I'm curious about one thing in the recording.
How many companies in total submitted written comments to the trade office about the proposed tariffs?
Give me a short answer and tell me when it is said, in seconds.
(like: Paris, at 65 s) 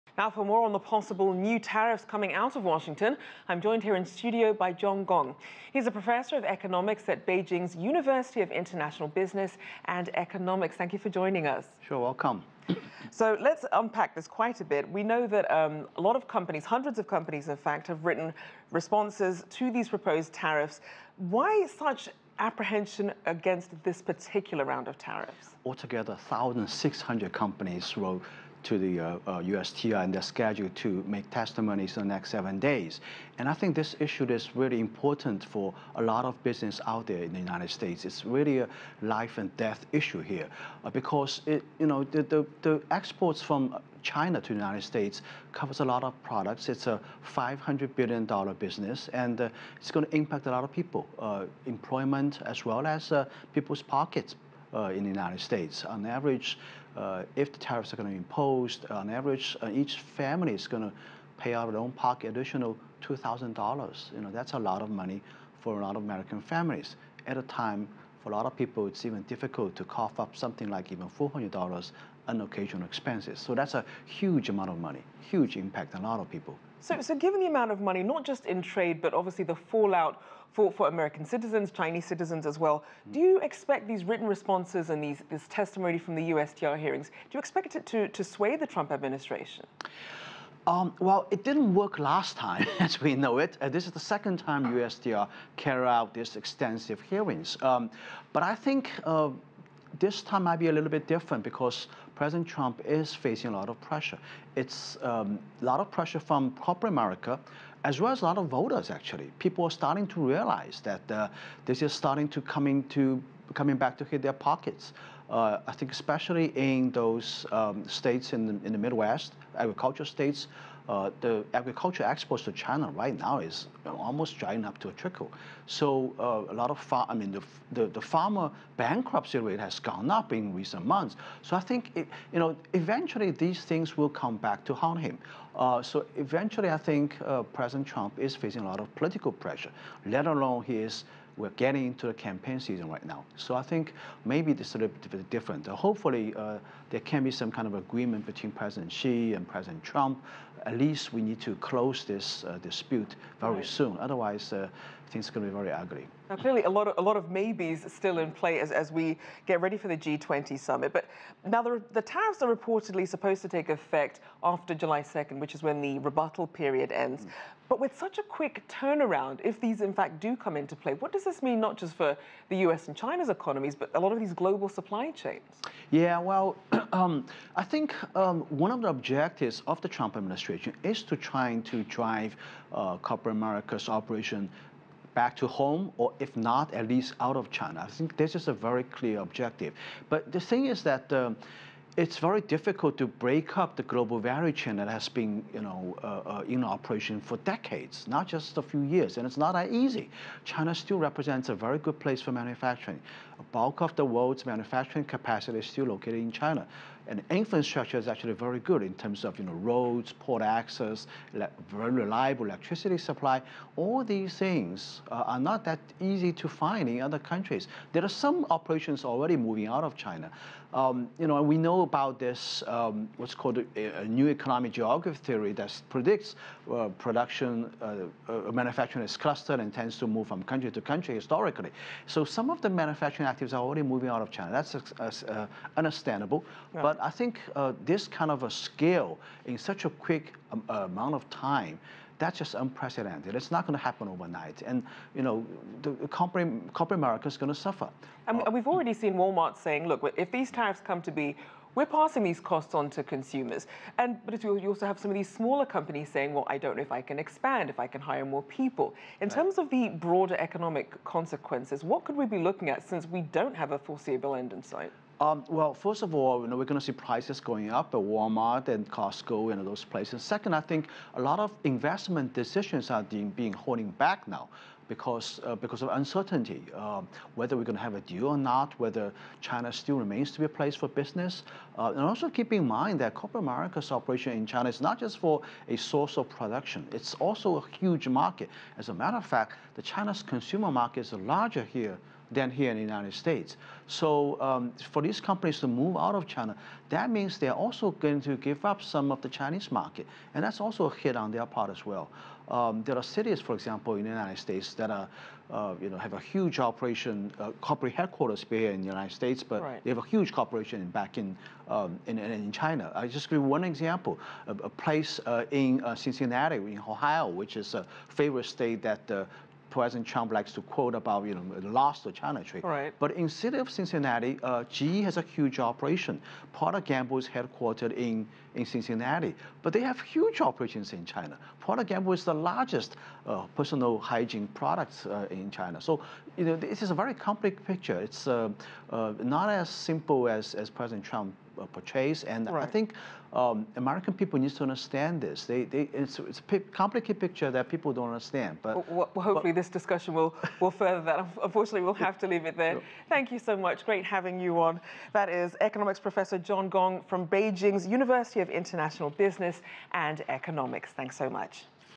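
1,600, at 26 s.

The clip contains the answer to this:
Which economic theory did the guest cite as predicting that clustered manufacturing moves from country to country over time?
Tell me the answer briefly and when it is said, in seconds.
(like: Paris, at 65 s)
new economic geography, at 224 s.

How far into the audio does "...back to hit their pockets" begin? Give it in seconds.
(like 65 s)
113 s.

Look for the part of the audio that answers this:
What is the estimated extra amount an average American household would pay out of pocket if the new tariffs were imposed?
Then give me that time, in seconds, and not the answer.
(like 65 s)
63 s.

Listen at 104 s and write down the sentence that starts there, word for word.
It's um, a lot of pressure from corporate America, as well as a lot of voters, actually.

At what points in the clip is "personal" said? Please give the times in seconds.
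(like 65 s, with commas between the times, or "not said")
333 s.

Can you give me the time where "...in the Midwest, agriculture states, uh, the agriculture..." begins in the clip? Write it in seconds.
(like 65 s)
118 s.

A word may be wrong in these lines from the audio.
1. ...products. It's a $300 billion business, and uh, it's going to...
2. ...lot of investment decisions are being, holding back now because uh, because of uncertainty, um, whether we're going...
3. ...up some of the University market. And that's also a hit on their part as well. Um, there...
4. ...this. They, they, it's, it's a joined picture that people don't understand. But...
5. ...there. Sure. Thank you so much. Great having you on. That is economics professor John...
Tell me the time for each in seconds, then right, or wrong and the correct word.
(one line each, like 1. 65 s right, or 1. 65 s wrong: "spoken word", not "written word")
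1. 46 s wrong: "500", not "300"
2. 271 s right
3. 298 s wrong: "Chinese", not "University"
4. 345 s wrong: "complicated", not "joined"
5. 352 s right.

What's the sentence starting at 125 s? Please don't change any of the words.
So uh, a lot of far, I mean, the, the, the, farmer bankruptcy rate has gone up in recent months.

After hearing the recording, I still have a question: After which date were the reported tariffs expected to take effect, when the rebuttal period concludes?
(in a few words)
July 2nd.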